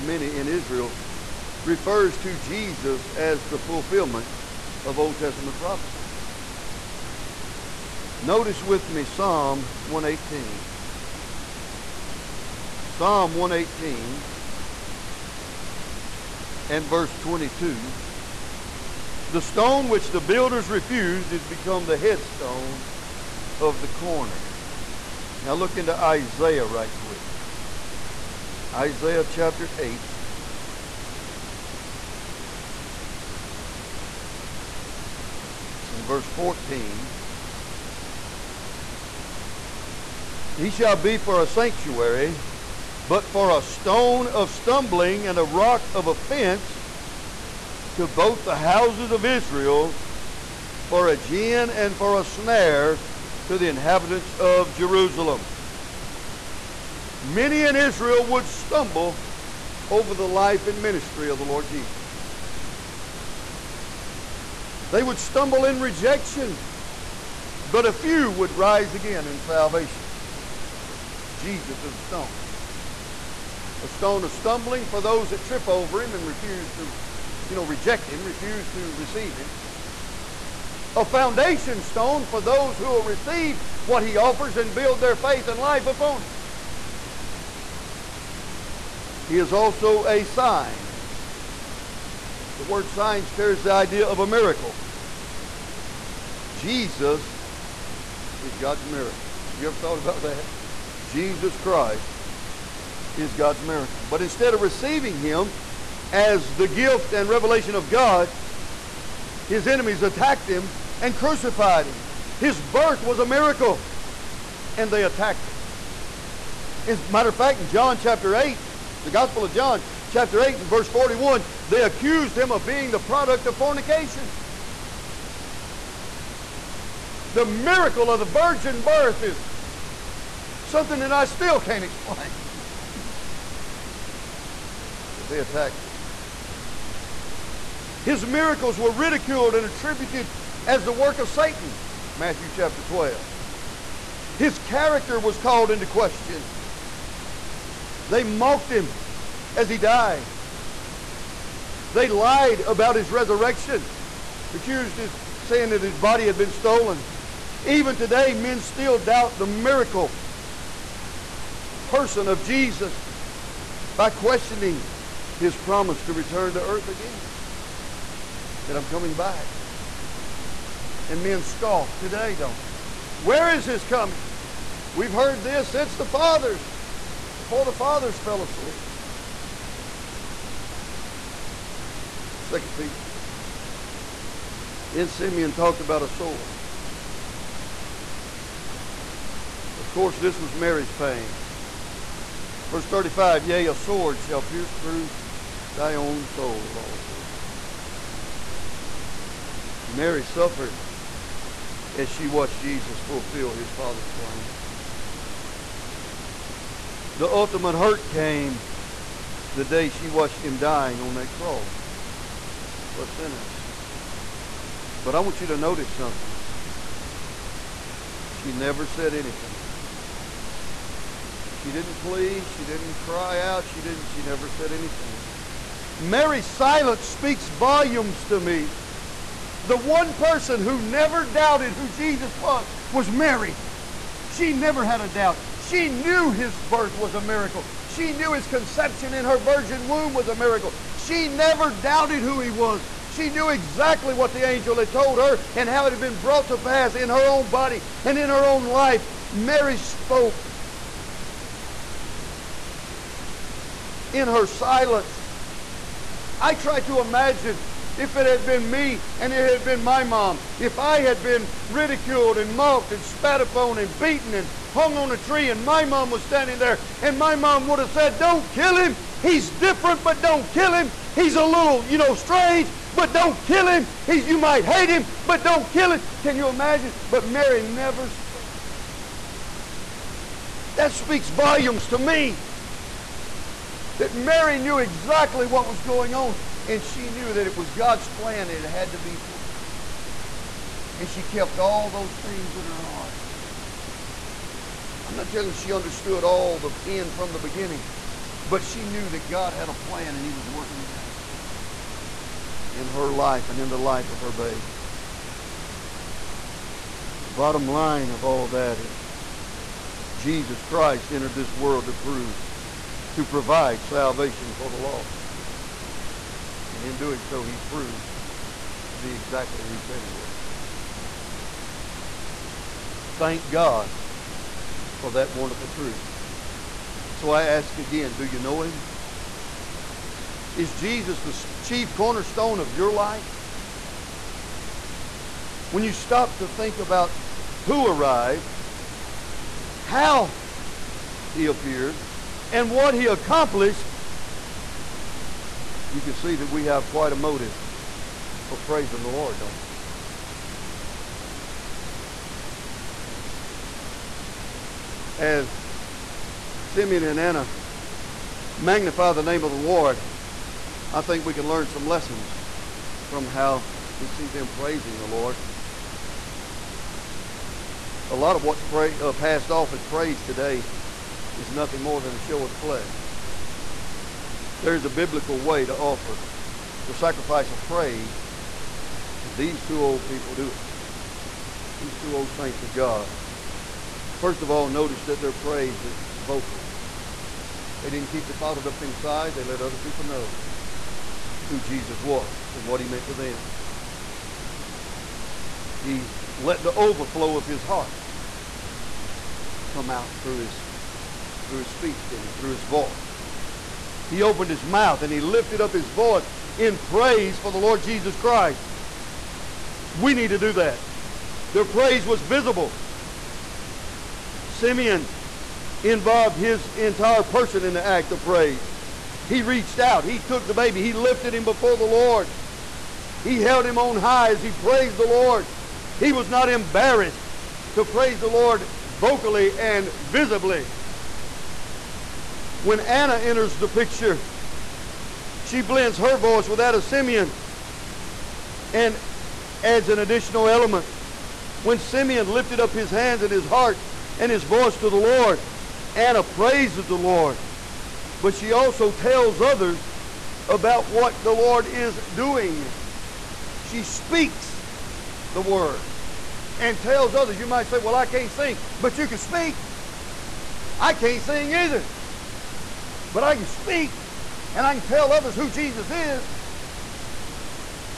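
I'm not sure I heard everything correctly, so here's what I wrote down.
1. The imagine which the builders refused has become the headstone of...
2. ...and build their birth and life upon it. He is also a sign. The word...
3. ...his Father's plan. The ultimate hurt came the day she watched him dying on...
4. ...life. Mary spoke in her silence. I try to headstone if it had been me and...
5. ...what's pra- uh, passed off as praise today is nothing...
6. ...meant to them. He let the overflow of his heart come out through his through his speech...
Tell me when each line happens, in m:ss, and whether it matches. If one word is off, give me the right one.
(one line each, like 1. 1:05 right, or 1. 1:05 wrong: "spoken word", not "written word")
1. 0:19 wrong: "stone", not "imagine"
2. 1:24 wrong: "faith", not "birth"
3. 3:23 right
4. 4:08 wrong: "imagine", not "headstone"
5. 6:08 right
6. 6:32 right.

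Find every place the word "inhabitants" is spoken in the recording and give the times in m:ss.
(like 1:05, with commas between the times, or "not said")
0:53.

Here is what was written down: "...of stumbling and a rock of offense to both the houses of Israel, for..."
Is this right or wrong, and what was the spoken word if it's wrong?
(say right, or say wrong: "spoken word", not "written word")
right.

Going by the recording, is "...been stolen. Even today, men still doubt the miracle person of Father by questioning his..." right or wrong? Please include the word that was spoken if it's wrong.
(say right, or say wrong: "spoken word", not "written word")
wrong: "Jesus", not "Father".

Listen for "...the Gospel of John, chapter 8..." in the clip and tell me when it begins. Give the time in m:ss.
1:59.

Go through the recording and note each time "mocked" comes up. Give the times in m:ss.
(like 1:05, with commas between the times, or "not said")
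2:28, 4:22.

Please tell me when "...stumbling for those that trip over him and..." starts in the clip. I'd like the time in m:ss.
1:14.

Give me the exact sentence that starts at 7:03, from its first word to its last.
He held him on high as he praised the Lord.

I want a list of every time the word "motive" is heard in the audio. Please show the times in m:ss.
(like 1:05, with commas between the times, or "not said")
5:47.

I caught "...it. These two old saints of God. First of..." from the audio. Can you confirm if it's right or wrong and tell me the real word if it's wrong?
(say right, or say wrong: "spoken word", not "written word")
right.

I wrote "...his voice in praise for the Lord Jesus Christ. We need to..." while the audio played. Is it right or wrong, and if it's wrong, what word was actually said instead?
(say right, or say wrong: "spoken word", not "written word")
right.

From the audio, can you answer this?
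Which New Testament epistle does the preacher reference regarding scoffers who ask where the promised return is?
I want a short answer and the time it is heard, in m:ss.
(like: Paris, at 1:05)
Second Peter, at 3:02.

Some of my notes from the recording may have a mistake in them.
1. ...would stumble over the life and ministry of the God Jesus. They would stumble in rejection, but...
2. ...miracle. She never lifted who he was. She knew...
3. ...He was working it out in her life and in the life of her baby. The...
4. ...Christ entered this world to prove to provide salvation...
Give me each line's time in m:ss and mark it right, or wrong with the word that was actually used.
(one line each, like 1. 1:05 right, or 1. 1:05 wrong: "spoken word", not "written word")
1. 0:58 wrong: "Lord", not "God"
2. 4:00 wrong: "doubted", not "lifted"
3. 5:00 right
4. 5:10 right.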